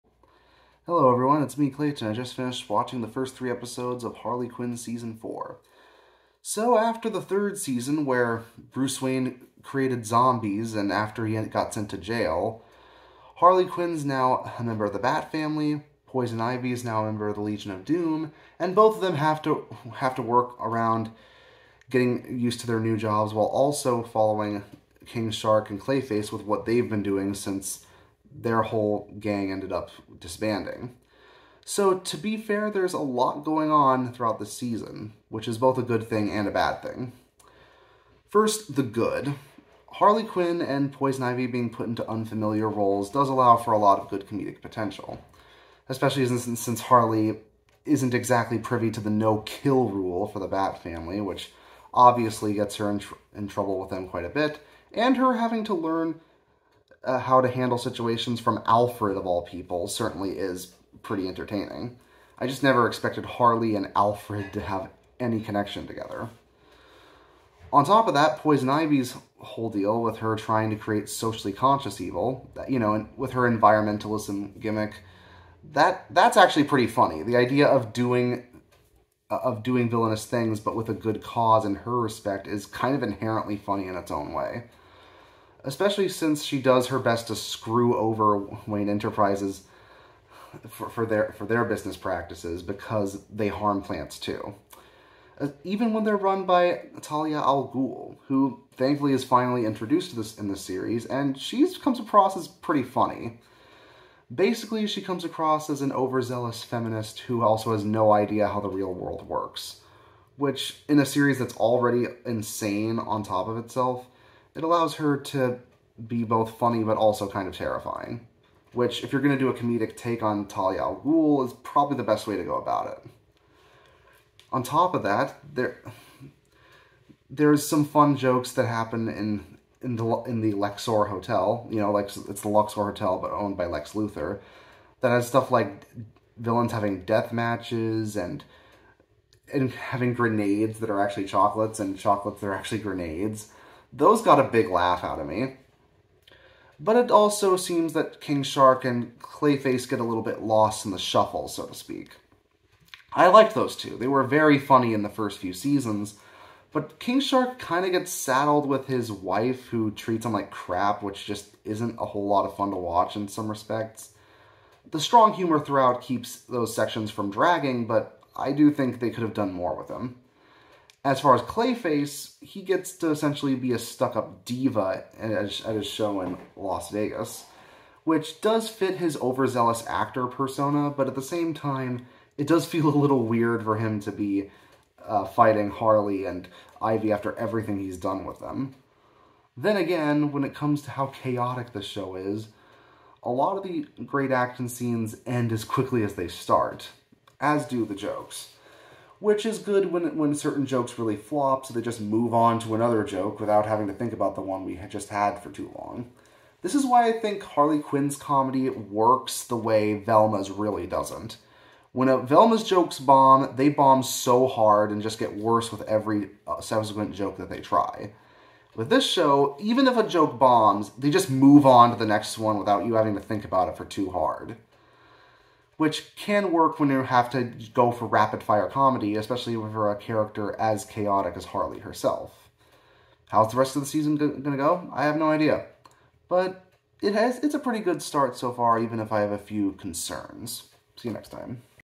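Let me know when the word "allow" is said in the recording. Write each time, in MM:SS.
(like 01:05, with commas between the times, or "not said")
00:43, 01:54.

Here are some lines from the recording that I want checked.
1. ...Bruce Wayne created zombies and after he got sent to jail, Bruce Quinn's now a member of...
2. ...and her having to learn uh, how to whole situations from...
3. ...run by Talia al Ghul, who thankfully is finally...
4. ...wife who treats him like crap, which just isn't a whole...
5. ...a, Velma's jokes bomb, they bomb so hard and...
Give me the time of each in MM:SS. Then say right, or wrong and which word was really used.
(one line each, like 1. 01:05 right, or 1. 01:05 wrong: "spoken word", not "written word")
1. 00:08 wrong: "Harley", not "Bruce"
2. 00:54 wrong: "handle", not "whole"
3. 01:36 right
4. 02:39 right
5. 03:32 right.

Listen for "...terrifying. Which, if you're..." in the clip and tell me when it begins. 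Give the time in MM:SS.
01:57.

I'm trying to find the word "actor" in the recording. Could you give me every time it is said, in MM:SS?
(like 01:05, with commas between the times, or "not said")
02:59.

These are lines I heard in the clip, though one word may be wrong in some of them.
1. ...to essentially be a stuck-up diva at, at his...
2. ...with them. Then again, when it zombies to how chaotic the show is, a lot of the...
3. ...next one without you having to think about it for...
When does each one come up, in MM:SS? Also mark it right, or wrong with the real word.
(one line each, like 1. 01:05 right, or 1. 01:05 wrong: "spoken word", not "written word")
1. 02:52 right
2. 03:08 wrong: "comes", not "zombies"
3. 03:42 right.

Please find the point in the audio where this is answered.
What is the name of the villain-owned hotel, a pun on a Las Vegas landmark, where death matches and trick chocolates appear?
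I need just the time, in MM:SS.
02:10.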